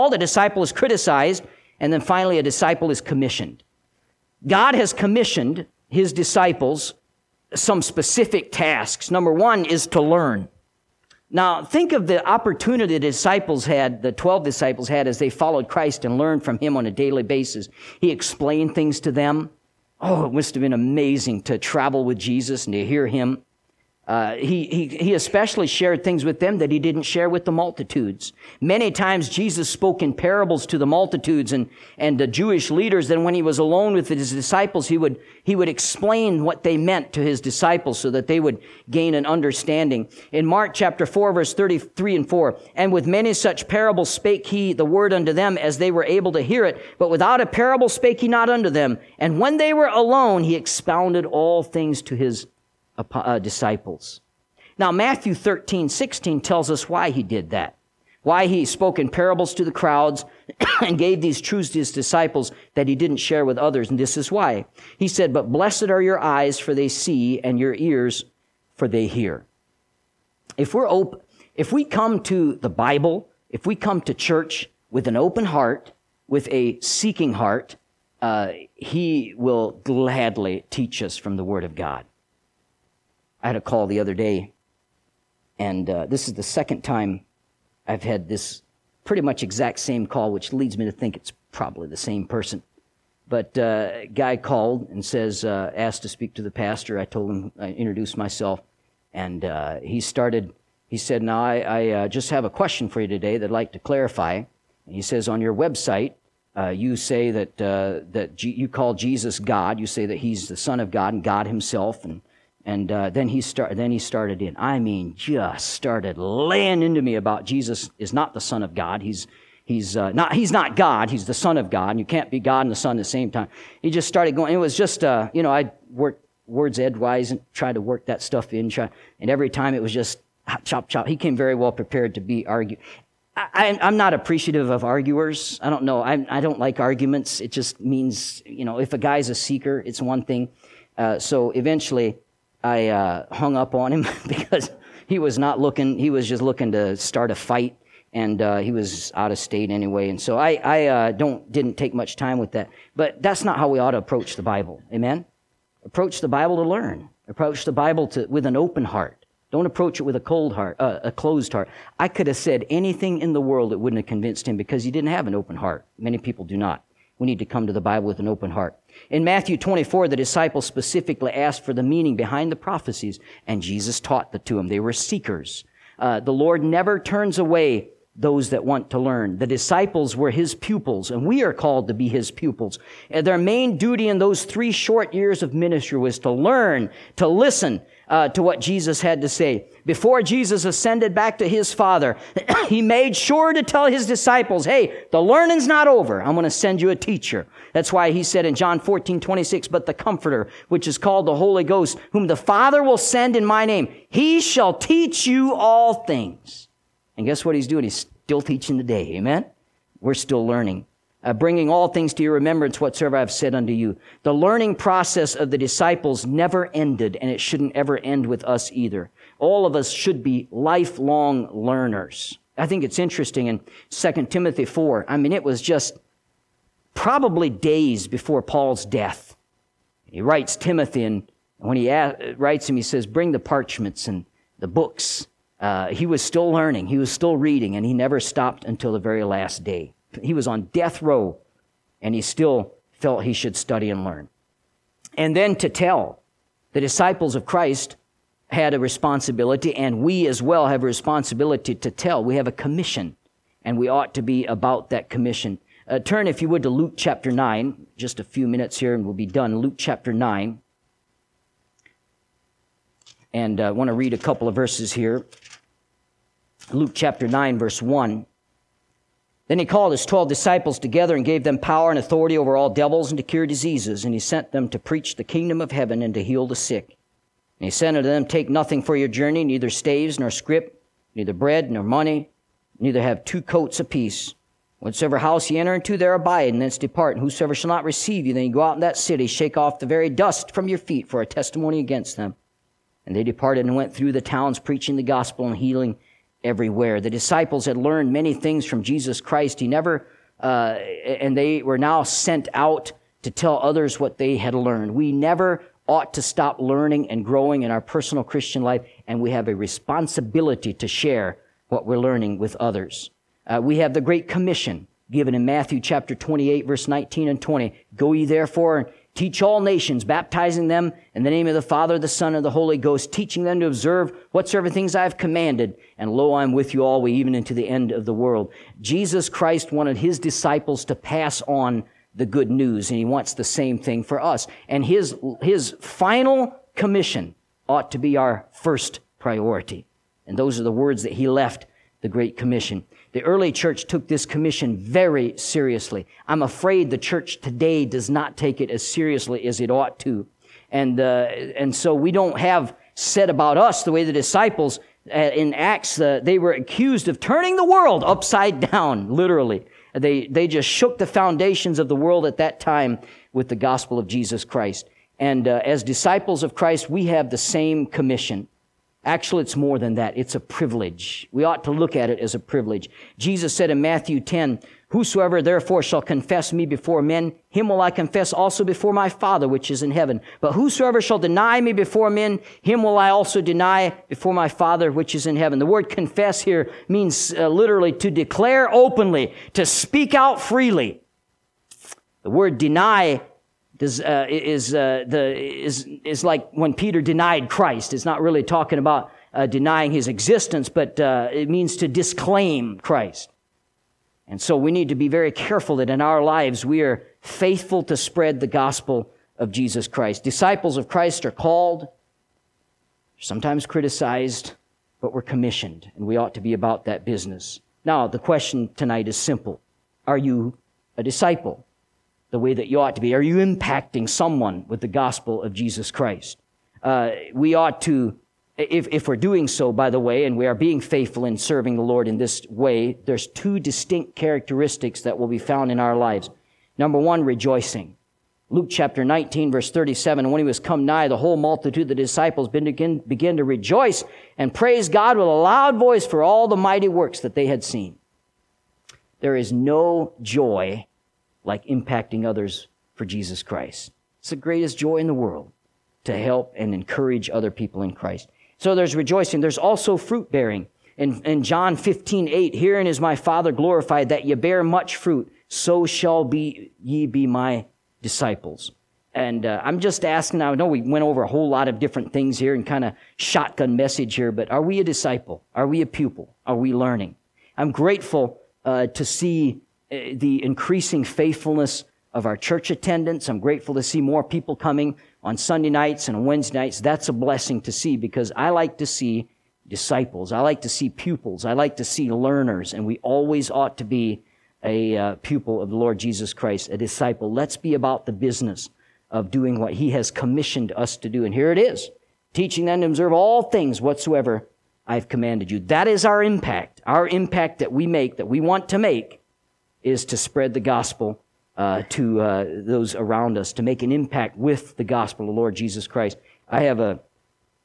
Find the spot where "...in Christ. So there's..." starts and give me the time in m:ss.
7:37.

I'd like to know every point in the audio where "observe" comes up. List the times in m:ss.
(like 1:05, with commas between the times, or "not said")
5:23, 8:22.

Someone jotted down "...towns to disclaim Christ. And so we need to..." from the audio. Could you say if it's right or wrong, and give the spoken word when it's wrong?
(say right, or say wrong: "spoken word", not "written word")
wrong: "means", not "towns".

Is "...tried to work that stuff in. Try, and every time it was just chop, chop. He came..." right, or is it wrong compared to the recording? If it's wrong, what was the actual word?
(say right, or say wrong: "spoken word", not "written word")
right.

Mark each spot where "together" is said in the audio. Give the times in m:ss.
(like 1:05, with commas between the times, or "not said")
4:30.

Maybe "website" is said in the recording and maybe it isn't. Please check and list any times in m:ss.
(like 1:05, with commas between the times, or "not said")
1:45.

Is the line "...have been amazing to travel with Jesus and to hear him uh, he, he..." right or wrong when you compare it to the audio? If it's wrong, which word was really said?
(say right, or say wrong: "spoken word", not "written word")
right.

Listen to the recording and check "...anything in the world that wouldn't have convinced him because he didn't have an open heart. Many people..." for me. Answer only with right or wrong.
right.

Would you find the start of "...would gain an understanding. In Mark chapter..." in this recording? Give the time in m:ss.
0:38.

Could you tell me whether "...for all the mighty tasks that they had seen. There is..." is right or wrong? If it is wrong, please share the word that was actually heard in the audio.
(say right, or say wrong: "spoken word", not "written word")
wrong: "works", not "tasks".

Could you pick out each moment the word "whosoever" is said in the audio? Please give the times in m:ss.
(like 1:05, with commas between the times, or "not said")
4:47, 6:14, 6:20.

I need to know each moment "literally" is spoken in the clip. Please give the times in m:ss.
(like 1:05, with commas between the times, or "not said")
5:59, 6:27.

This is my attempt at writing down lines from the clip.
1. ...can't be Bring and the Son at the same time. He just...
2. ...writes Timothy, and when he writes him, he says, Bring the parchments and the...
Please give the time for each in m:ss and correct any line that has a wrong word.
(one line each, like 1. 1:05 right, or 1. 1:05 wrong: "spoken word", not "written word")
1. 2:02 wrong: "God", not "Bring"
2. 3:50 right.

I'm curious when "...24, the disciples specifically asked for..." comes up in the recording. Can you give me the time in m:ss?
2:49.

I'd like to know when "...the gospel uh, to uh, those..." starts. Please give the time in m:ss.
8:30.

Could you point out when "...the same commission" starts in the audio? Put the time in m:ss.
6:07.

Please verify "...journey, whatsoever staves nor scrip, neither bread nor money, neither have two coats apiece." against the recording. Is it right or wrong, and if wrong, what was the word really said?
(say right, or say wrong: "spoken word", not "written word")
wrong: "neither", not "whatsoever".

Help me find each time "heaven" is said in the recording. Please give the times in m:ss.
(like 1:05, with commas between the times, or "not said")
4:35, 6:19, 6:25.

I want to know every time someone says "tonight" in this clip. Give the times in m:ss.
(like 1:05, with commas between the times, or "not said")
6:58.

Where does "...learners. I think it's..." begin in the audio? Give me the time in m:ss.
3:41.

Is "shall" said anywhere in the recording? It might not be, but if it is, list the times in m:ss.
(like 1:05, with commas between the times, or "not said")
3:24, 4:47, 6:15, 6:21, 7:45.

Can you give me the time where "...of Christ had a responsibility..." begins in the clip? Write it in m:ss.
4:07.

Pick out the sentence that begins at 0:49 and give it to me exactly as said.
And when they were alone, he expounded all things to his uh, disciples.